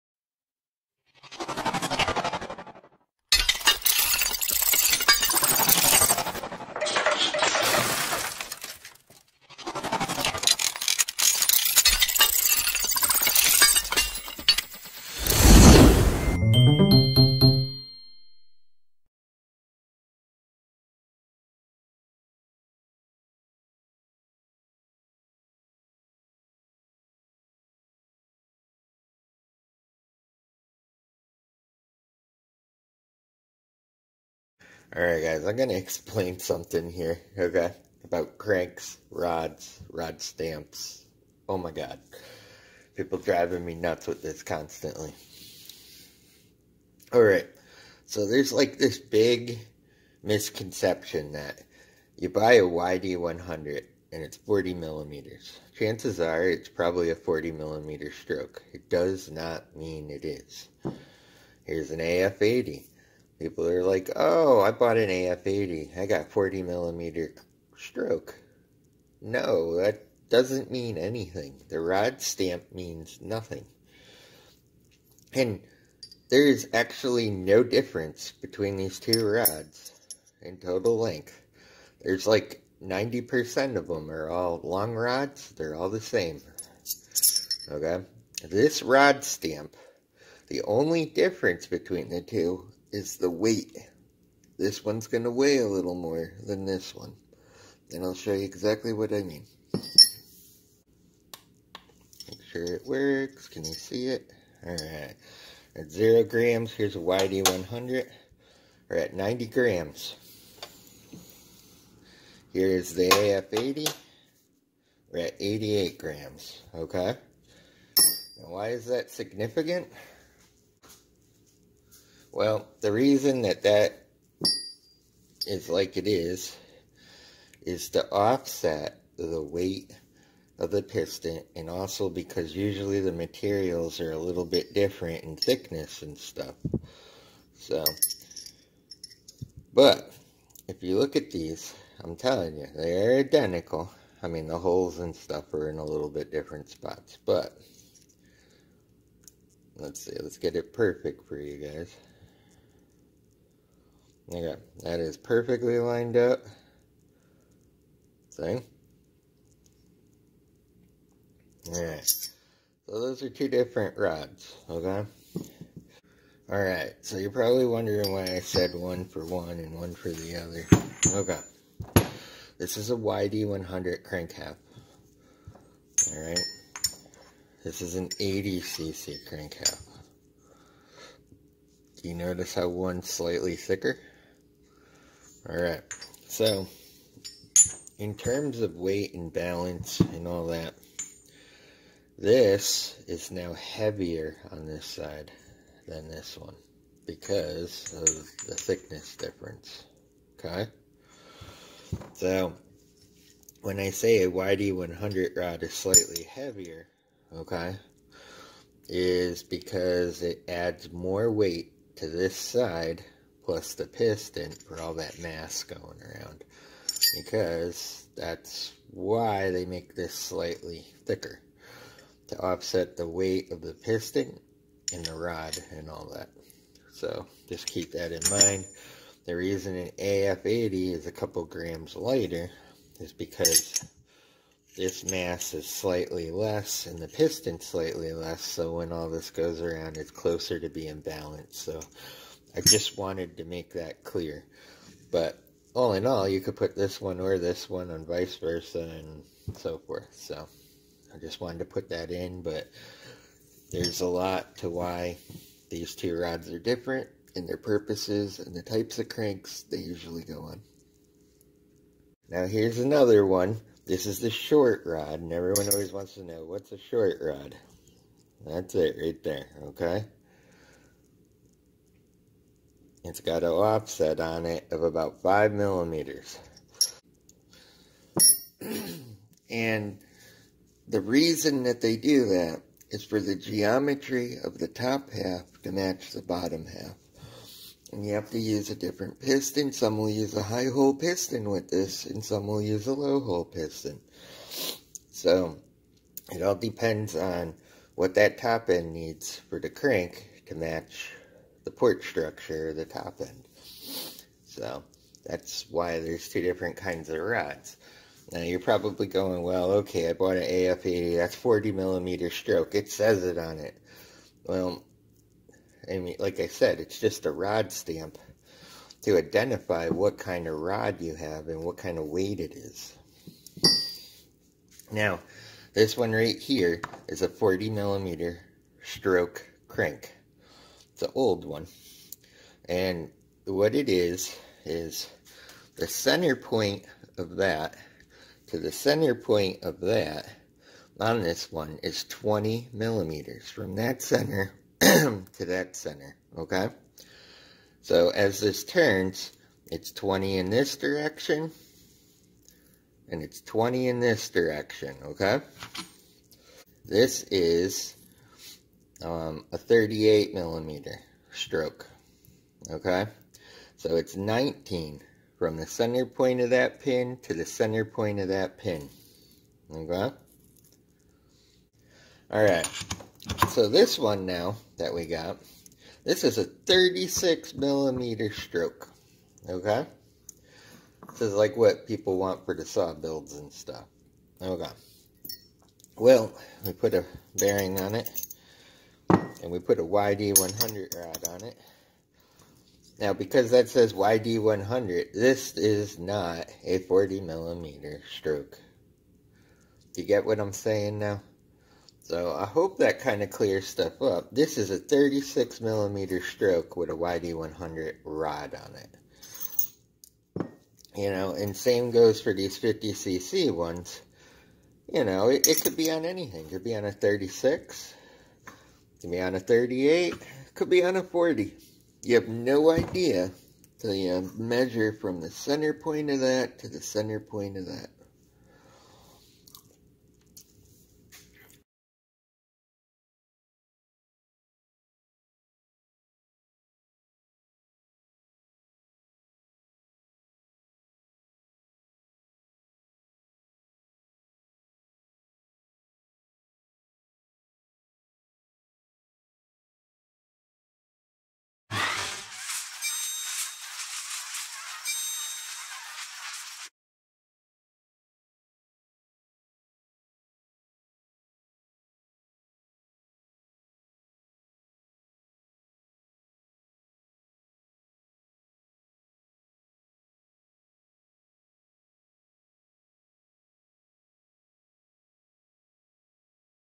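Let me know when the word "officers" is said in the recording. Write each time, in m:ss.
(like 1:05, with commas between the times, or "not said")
not said.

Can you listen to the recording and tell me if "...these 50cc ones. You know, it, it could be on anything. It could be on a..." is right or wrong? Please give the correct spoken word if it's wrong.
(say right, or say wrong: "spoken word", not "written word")
right.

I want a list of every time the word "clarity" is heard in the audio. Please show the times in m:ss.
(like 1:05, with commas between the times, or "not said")
not said.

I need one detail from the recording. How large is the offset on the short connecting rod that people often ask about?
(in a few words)
About 5 millimeters.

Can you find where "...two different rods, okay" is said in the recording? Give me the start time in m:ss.
2:43.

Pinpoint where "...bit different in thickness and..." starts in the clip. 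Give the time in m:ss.
2:14.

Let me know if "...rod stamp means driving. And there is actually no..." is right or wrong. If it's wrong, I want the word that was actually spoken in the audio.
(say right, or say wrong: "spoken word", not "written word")
wrong: "nothing", not "driving".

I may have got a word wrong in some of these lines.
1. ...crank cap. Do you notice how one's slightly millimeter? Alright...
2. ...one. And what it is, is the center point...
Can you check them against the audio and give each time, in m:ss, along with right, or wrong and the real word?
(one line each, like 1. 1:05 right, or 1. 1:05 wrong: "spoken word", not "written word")
1. 2:59 wrong: "thicker", not "millimeter"
2. 5:31 right.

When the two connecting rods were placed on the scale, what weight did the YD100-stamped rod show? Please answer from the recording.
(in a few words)
90 grams.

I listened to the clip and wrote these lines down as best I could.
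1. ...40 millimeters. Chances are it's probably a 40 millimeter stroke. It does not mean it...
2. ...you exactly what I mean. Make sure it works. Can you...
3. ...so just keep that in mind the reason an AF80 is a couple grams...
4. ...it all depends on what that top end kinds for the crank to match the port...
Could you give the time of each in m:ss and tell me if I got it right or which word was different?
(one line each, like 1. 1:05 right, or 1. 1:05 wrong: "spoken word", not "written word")
1. 0:54 right
2. 1:38 right
3. 3:46 right
4. 4:56 wrong: "needs", not "kinds".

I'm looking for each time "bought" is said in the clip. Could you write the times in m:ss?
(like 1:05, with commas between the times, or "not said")
1:04, 5:10.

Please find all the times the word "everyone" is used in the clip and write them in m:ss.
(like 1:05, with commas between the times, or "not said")
4:25.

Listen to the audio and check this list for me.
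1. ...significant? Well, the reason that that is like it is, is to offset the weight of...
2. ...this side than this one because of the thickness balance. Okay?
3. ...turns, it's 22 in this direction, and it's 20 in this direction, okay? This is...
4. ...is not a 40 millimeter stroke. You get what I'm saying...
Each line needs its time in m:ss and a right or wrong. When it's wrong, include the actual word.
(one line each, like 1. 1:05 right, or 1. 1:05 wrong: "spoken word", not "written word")
1. 1:59 right
2. 3:14 wrong: "difference", not "balance"
3. 5:48 wrong: "20", not "22"
4. 6:35 right.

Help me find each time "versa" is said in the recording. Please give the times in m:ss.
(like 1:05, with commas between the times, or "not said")
4:08.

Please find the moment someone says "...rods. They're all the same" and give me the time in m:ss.
1:24.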